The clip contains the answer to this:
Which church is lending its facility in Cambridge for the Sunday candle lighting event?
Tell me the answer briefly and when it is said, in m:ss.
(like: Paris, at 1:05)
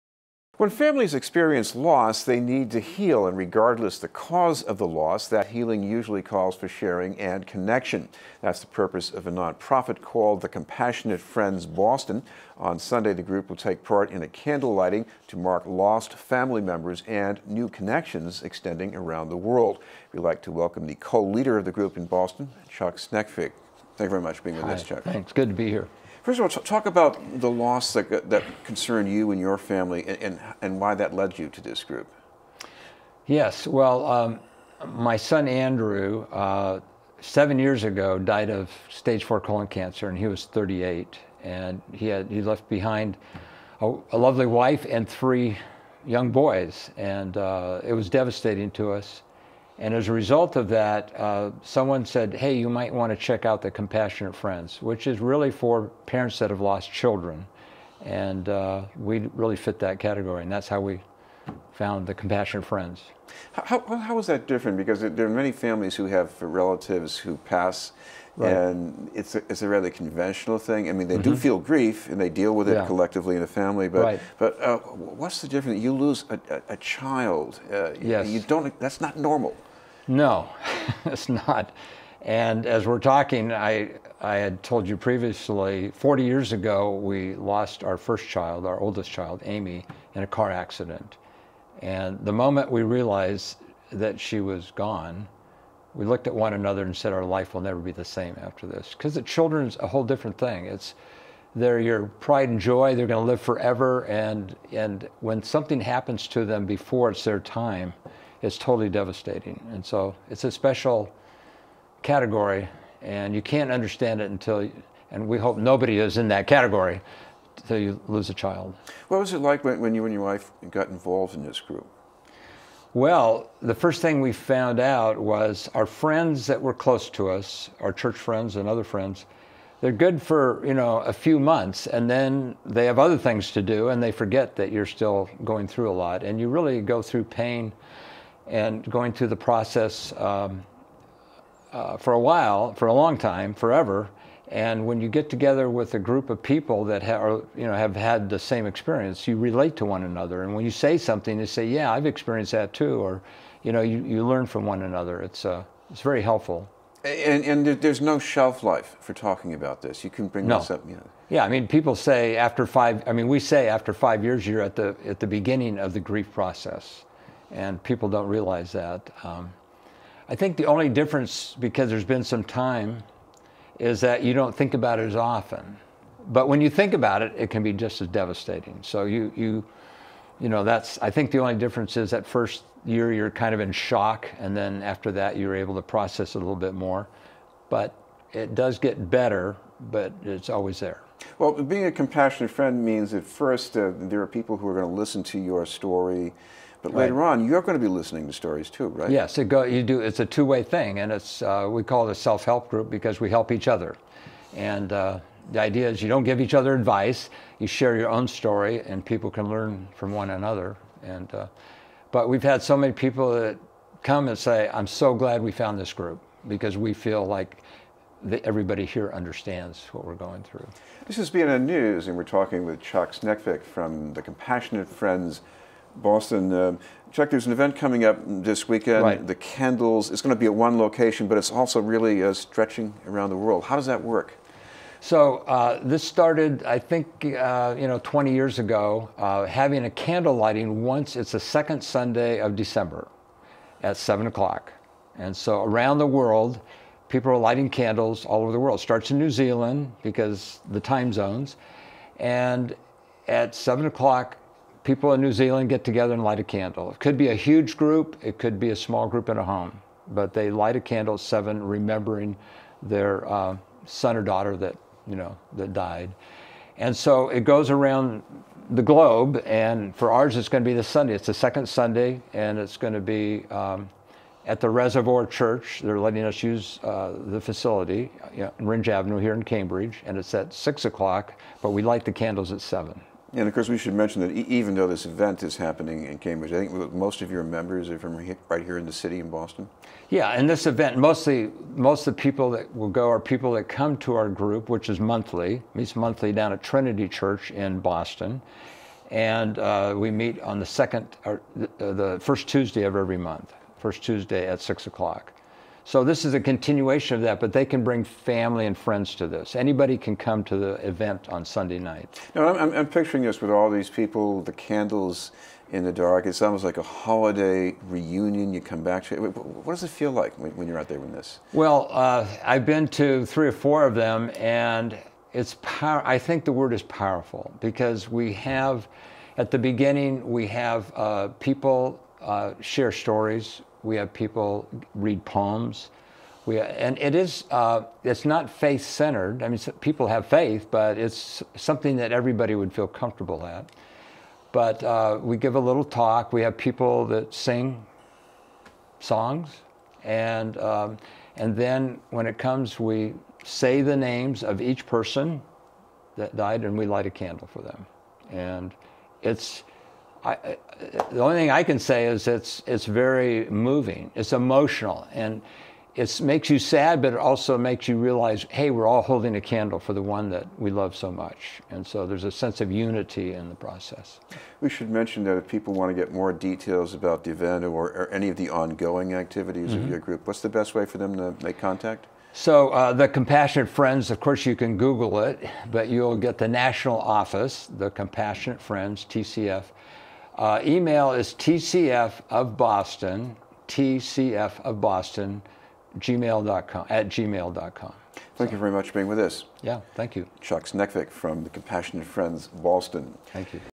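Reservoir Church, at 4:34.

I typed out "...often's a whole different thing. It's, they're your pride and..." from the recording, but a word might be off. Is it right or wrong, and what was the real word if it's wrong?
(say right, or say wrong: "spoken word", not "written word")
wrong: "children", not "often".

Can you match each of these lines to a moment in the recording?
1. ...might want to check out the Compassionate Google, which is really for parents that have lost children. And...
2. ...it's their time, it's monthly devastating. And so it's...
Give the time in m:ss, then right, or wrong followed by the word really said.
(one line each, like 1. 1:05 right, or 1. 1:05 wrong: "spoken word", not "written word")
1. 0:52 wrong: "Friends", not "Google"
2. 1:47 wrong: "totally", not "monthly".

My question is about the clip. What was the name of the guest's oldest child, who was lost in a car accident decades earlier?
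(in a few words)
Amy.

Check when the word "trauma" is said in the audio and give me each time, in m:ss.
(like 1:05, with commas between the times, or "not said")
not said.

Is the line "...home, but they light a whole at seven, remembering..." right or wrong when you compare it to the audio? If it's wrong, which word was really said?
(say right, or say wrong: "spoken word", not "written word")
wrong: "candle", not "whole".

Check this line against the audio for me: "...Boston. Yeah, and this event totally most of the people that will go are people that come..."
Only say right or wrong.
wrong.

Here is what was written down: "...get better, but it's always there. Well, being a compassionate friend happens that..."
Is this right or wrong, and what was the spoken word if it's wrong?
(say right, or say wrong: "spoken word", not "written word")
wrong: "means", not "happens".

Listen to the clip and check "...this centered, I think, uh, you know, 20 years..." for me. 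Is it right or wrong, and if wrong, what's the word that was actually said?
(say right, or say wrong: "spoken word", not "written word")
wrong: "started", not "centered".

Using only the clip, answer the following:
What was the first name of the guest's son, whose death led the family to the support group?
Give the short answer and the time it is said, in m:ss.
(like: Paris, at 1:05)
Andrew, at 0:35.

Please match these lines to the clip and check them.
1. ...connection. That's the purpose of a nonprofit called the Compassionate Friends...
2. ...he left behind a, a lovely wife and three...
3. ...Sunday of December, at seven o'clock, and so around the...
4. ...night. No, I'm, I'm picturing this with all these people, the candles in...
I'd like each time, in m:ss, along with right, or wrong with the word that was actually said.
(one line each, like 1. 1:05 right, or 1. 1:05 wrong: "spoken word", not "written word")
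1. 0:07 right
2. 0:42 right
3. 4:01 right
4. 5:11 right.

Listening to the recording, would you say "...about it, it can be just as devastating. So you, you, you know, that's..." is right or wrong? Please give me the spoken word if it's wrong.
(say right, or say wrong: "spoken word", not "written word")
right.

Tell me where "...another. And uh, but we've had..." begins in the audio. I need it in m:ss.
3:30.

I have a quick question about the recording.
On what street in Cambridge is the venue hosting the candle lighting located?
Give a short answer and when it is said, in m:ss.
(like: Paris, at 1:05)
Rindge Avenue, at 4:38.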